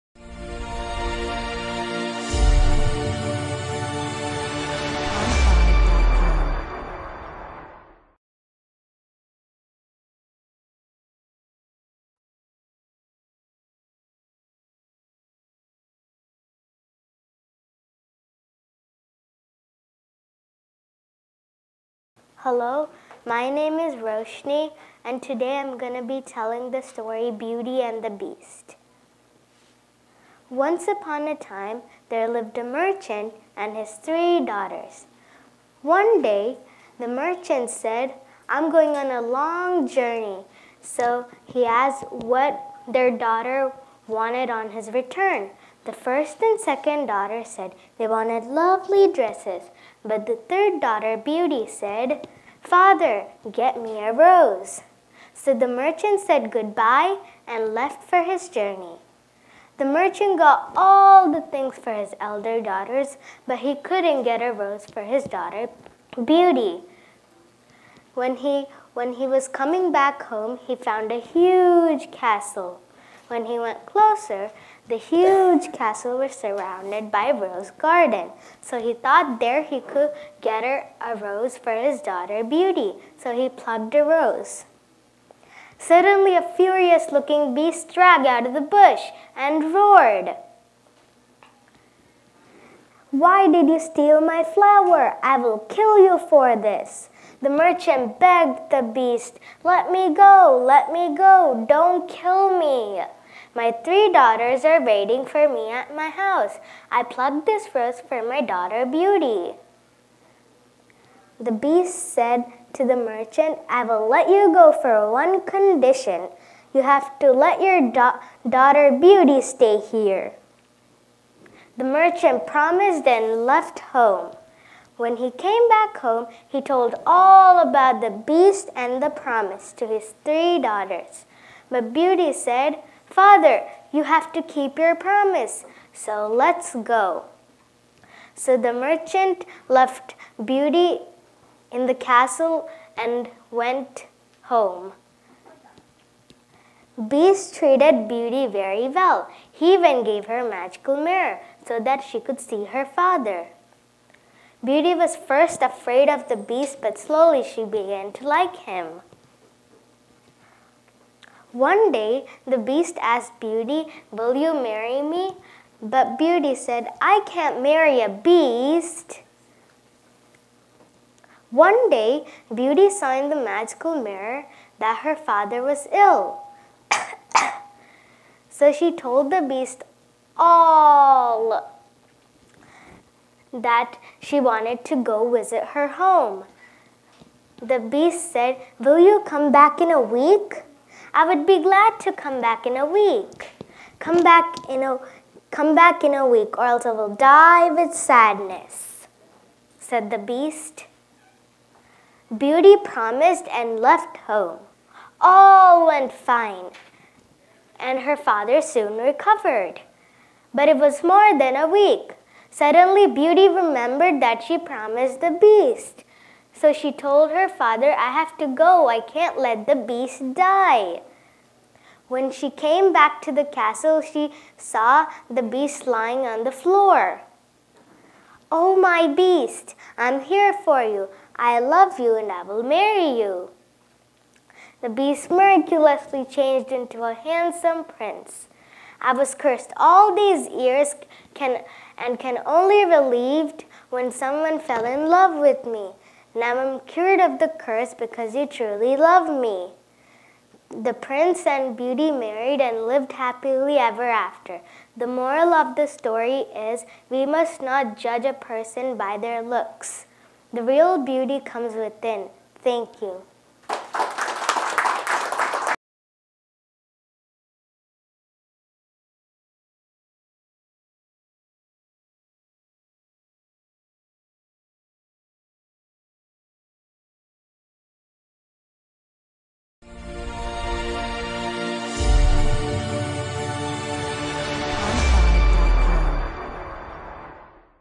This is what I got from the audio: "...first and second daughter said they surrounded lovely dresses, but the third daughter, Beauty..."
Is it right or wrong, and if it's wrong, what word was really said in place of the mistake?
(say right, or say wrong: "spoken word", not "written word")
wrong: "wanted", not "surrounded".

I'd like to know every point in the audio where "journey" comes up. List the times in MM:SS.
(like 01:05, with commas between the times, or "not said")
00:39, 00:58.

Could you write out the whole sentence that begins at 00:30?
Once upon a time, there lived a merchant and his three daughters.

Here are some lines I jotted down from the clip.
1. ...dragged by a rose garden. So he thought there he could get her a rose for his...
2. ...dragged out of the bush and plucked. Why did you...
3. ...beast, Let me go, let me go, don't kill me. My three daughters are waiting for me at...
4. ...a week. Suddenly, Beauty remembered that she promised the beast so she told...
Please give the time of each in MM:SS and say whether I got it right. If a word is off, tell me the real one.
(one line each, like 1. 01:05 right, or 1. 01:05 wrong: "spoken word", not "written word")
1. 01:16 wrong: "surrounded", not "dragged"
2. 01:27 wrong: "roared", not "plucked"
3. 01:38 right
4. 03:31 right.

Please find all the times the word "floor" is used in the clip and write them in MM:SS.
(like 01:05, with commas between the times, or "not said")
03:46.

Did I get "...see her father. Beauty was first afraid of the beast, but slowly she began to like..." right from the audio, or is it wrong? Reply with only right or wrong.
right.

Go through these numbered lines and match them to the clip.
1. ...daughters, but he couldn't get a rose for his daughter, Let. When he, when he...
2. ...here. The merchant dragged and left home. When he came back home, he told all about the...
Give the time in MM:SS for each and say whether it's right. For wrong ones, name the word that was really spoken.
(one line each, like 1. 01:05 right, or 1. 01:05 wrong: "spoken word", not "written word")
1. 01:02 wrong: "Beauty", not "Let"
2. 01:59 wrong: "promised", not "dragged".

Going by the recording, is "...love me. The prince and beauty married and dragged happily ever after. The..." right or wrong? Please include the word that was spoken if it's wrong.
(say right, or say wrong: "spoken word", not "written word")
wrong: "lived", not "dragged".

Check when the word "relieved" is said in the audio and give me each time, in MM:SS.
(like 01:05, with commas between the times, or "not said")
04:02.